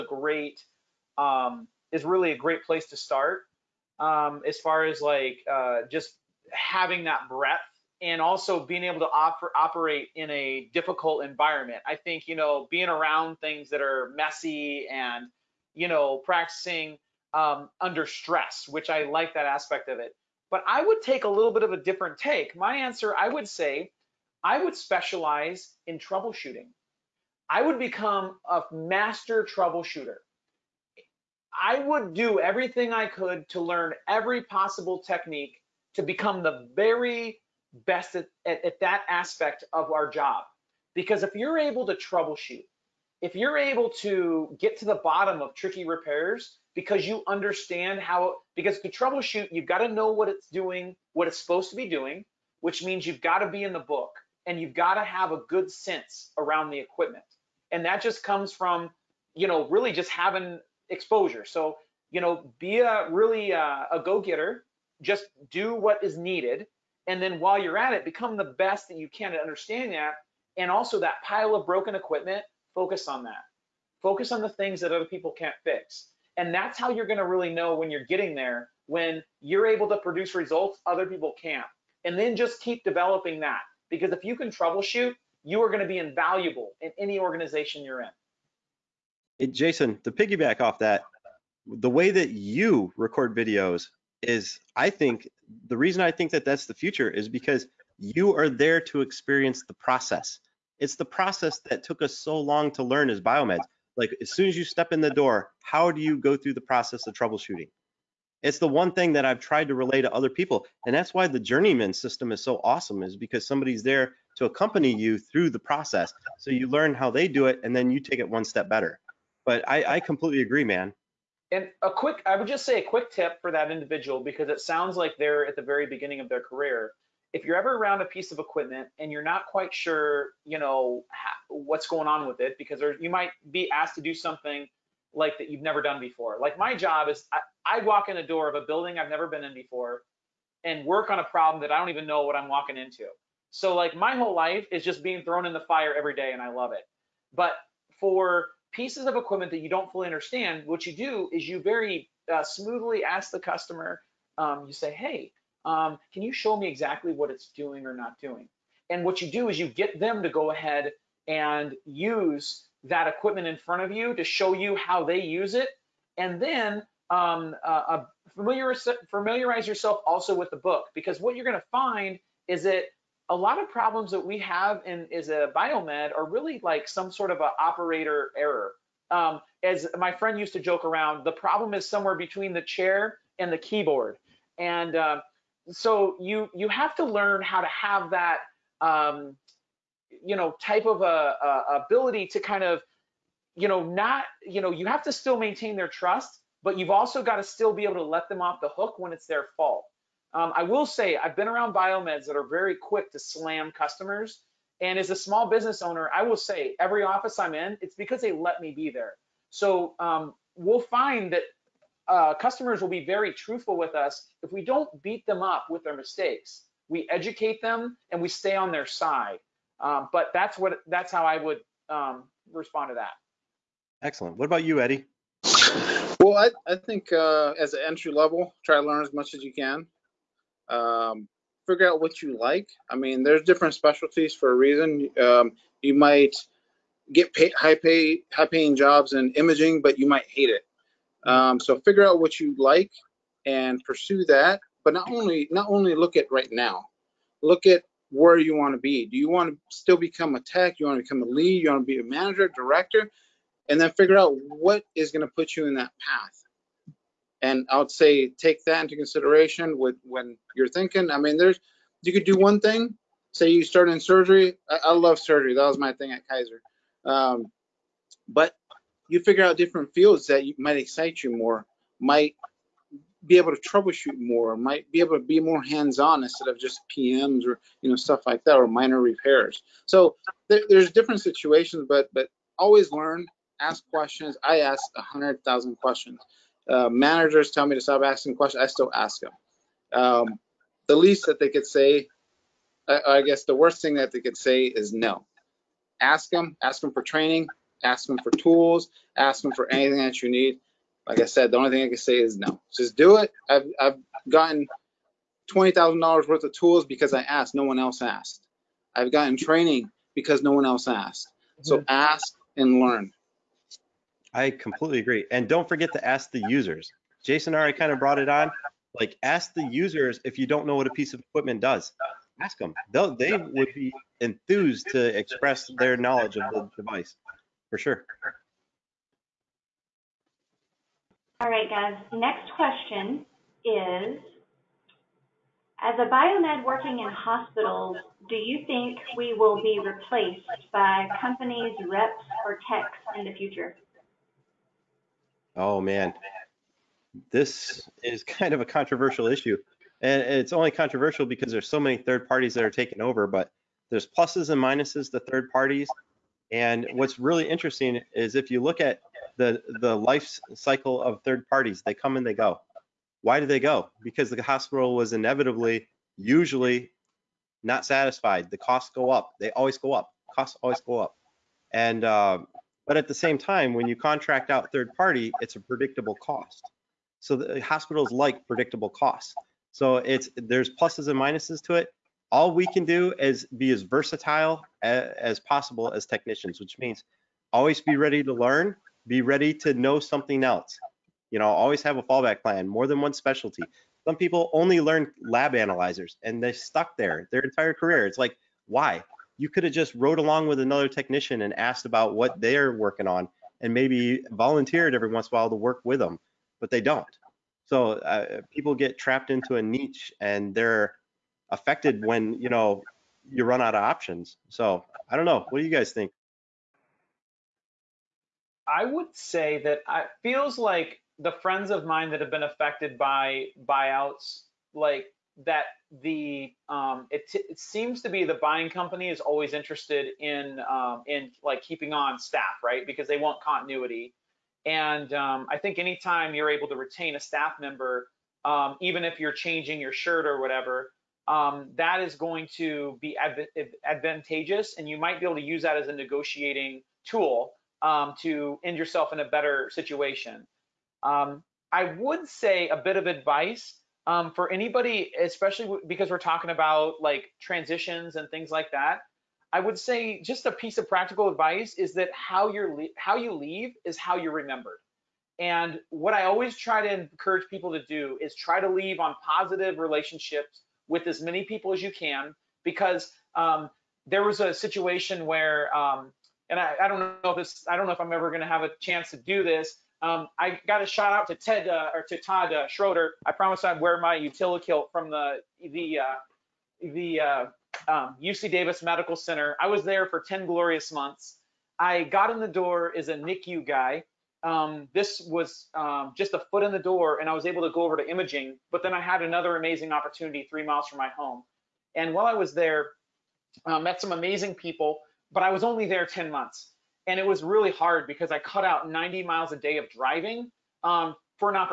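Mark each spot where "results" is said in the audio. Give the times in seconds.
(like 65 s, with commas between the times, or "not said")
80 s.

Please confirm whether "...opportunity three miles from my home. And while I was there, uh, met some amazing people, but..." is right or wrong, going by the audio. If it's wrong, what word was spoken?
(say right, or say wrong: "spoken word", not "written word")
right.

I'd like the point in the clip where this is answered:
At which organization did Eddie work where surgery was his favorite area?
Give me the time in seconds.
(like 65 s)
266 s.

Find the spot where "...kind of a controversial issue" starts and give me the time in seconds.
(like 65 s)
348 s.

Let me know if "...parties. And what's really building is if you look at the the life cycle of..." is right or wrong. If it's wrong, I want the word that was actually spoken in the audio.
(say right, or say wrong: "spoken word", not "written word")
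wrong: "interesting", not "building".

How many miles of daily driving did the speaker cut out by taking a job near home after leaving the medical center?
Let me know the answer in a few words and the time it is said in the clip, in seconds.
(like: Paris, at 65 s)
90, at 508 s.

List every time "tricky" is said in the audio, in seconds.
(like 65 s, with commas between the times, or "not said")
45 s.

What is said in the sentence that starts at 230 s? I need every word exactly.
Um, figure out what you like.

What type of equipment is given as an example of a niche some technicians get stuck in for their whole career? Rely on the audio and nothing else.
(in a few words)
Lab analyzers.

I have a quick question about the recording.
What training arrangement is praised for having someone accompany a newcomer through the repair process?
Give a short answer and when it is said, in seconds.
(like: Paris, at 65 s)
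The journeyman system, at 111 s.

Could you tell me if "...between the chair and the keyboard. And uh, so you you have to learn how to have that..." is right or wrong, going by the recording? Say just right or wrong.
right.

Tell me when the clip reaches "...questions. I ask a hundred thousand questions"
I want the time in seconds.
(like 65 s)
283 s.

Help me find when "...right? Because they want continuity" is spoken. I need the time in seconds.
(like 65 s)
432 s.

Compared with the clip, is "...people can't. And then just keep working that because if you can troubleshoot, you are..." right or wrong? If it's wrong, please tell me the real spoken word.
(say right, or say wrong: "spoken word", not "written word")
wrong: "developing", not "working".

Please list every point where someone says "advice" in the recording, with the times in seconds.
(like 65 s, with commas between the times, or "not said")
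453 s, 461 s.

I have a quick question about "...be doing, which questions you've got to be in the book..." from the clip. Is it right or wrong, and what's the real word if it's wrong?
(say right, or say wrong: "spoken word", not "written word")
wrong: "means", not "questions".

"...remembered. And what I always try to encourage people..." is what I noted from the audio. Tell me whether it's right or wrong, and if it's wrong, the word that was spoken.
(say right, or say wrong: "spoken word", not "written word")
right.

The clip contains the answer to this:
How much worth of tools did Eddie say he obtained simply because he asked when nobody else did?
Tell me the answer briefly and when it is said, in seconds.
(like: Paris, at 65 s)
$20,000, at 305 s.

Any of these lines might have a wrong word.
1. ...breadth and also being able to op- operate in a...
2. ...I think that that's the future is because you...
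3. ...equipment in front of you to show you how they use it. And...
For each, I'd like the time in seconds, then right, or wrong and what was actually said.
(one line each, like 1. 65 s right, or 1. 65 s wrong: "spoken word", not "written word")
1. 7 s right
2. 96 s right
3. 163 s right.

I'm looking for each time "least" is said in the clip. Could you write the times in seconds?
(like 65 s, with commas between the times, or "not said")
290 s.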